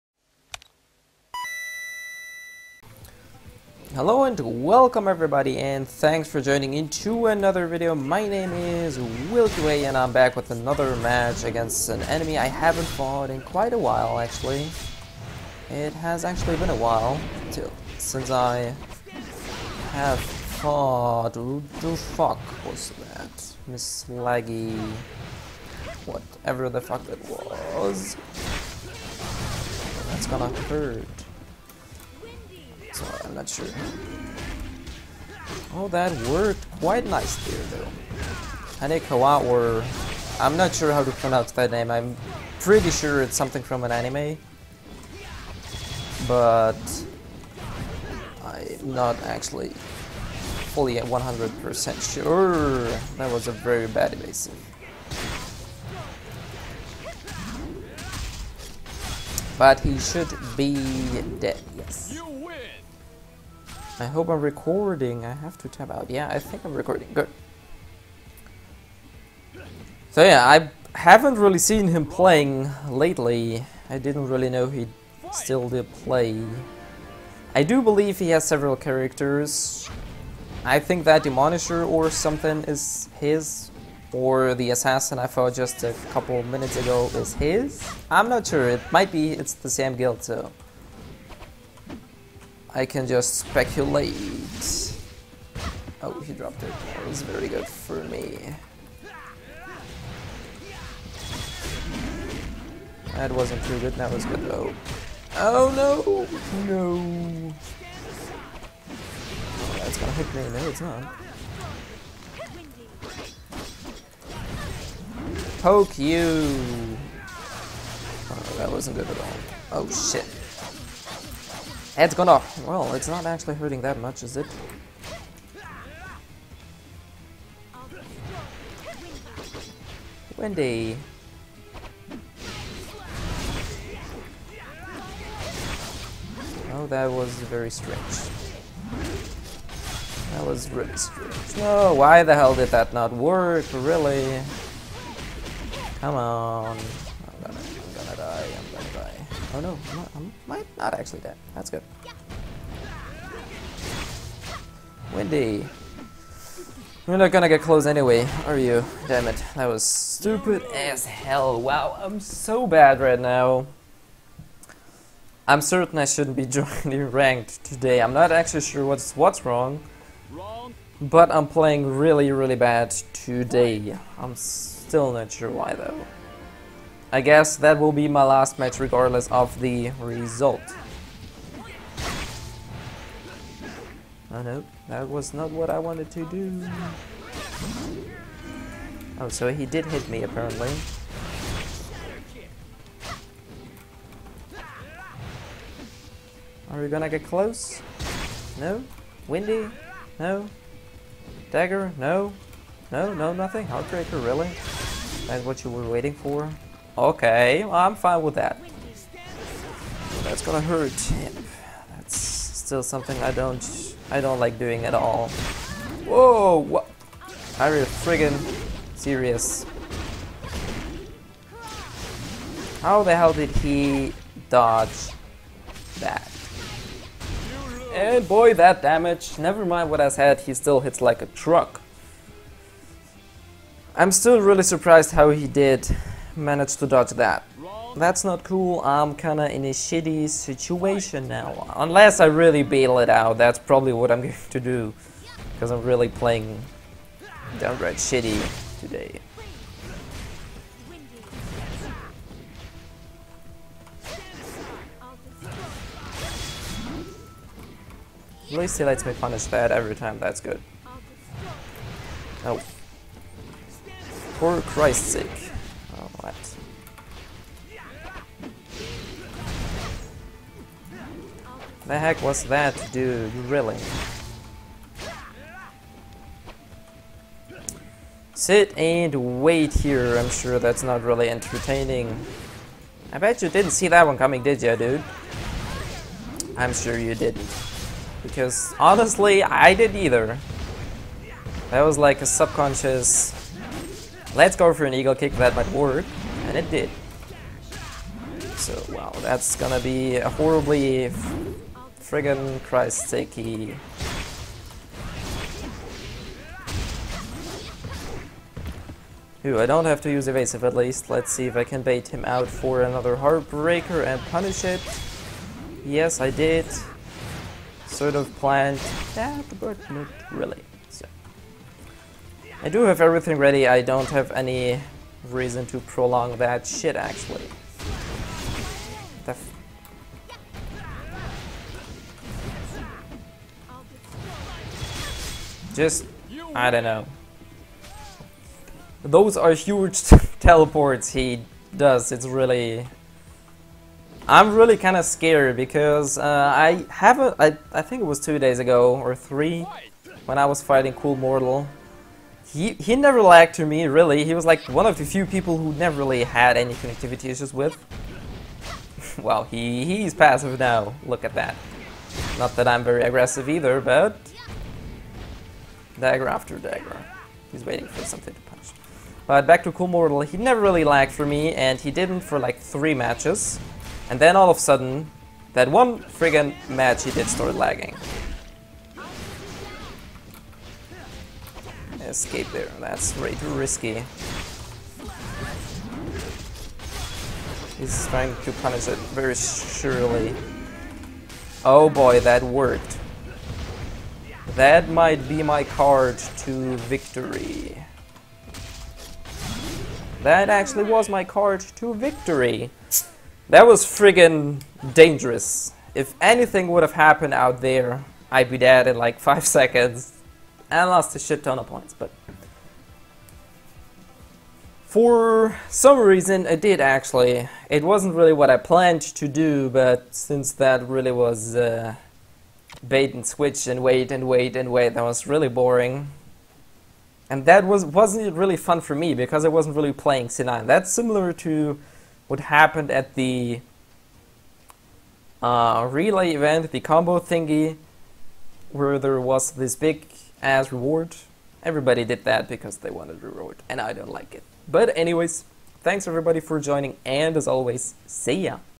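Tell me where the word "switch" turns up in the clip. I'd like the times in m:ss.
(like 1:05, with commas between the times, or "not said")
7:03.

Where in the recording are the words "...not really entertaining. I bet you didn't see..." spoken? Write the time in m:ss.
4:40.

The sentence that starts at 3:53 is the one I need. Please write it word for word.
I'm still really surprised how he did managed to dodge that.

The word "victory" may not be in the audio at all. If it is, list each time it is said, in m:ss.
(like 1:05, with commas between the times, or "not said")
6:36, 6:41.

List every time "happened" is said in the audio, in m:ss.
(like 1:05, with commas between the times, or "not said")
6:46, 7:12.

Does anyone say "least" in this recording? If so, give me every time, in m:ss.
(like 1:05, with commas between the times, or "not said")
4:18, 5:10.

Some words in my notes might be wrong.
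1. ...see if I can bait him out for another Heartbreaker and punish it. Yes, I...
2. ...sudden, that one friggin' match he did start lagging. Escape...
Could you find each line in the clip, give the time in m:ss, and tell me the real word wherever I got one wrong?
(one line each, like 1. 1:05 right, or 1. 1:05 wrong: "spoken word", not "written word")
1. 5:11 right
2. 6:14 right.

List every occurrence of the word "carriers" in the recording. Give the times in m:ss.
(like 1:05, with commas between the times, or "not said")
not said.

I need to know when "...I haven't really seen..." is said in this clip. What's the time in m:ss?
1:10.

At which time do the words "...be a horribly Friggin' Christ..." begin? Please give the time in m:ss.
4:59.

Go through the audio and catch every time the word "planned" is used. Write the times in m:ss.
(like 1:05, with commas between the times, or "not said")
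5:18, 6:58.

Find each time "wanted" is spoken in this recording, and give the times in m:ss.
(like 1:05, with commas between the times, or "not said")
3:05, 7:22.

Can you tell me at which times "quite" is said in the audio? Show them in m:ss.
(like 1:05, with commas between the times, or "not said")
0:13, 0:36.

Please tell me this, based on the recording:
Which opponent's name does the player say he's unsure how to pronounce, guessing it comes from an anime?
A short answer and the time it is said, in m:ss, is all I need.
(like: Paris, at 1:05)
Tanekawa, at 0:38.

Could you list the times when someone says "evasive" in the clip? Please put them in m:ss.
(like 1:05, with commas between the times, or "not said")
0:54, 5:10.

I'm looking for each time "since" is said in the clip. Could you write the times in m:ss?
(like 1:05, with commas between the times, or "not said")
0:17, 7:00.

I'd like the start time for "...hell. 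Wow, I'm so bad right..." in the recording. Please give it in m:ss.
2:41.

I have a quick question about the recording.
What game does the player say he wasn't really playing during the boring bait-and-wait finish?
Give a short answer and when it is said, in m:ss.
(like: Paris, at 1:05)
C9, at 7:10.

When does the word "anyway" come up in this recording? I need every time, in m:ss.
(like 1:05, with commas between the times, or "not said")
2:37, 7:24.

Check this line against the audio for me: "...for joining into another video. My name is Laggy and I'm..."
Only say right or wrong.
wrong.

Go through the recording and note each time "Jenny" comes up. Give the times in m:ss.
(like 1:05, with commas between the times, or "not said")
not said.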